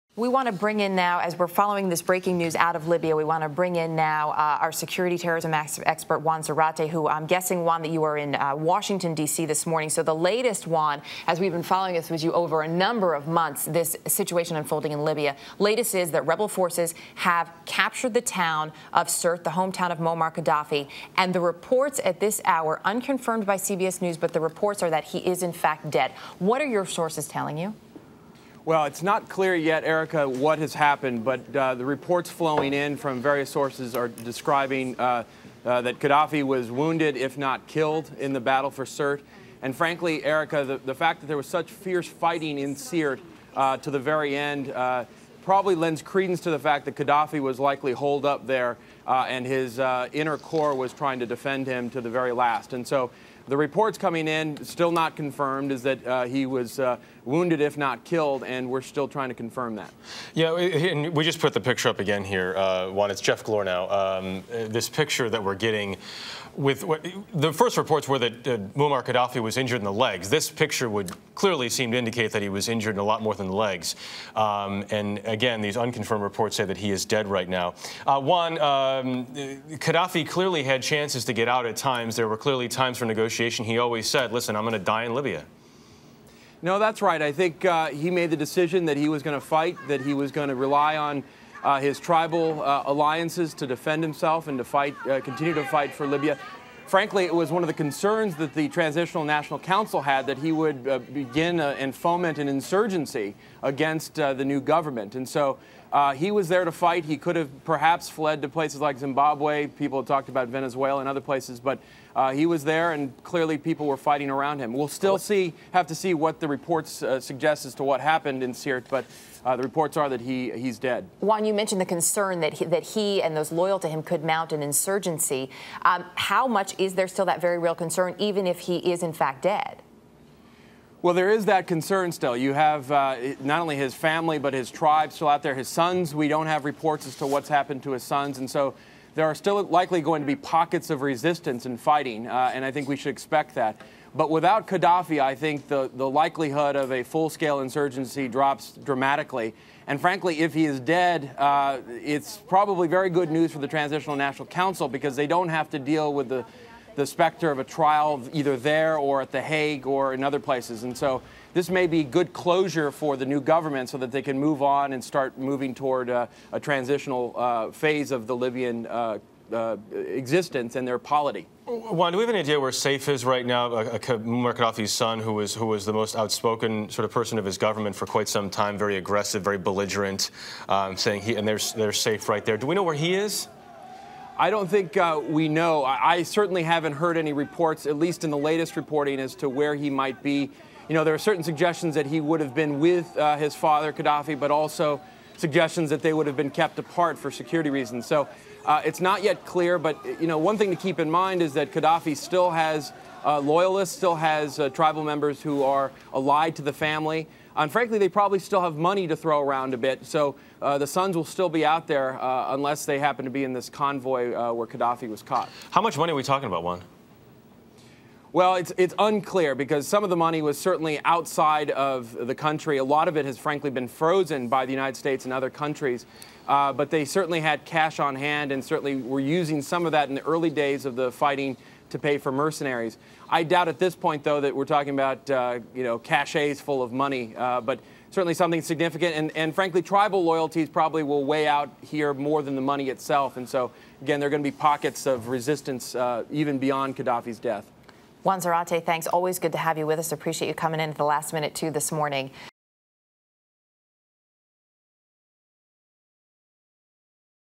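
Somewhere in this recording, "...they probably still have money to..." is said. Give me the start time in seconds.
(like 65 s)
207 s.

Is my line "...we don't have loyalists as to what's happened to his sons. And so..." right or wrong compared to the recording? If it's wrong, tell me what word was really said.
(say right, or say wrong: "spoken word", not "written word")
wrong: "reports", not "loyalists".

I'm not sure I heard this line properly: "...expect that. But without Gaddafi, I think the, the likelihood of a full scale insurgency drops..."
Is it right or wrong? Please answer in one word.
right.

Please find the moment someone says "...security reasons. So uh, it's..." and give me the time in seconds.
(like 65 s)
197 s.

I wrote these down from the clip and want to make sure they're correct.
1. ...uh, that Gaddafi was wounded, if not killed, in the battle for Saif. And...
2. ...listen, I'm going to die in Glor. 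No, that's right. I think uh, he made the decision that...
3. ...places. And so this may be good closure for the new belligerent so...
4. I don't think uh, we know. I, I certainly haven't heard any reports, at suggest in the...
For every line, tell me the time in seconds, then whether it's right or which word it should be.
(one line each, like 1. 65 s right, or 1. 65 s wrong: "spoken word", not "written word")
1. 35 s wrong: "Sirte", not "Saif"
2. 84 s wrong: "Libya", not "Glor"
3. 160 s wrong: "government", not "belligerent"
4. 184 s wrong: "least", not "suggest".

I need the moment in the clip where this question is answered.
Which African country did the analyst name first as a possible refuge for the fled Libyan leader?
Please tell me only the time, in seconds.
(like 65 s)
108 s.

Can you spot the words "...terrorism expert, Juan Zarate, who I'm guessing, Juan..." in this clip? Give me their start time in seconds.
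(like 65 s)
5 s.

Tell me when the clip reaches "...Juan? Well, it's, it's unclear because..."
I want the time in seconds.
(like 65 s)
216 s.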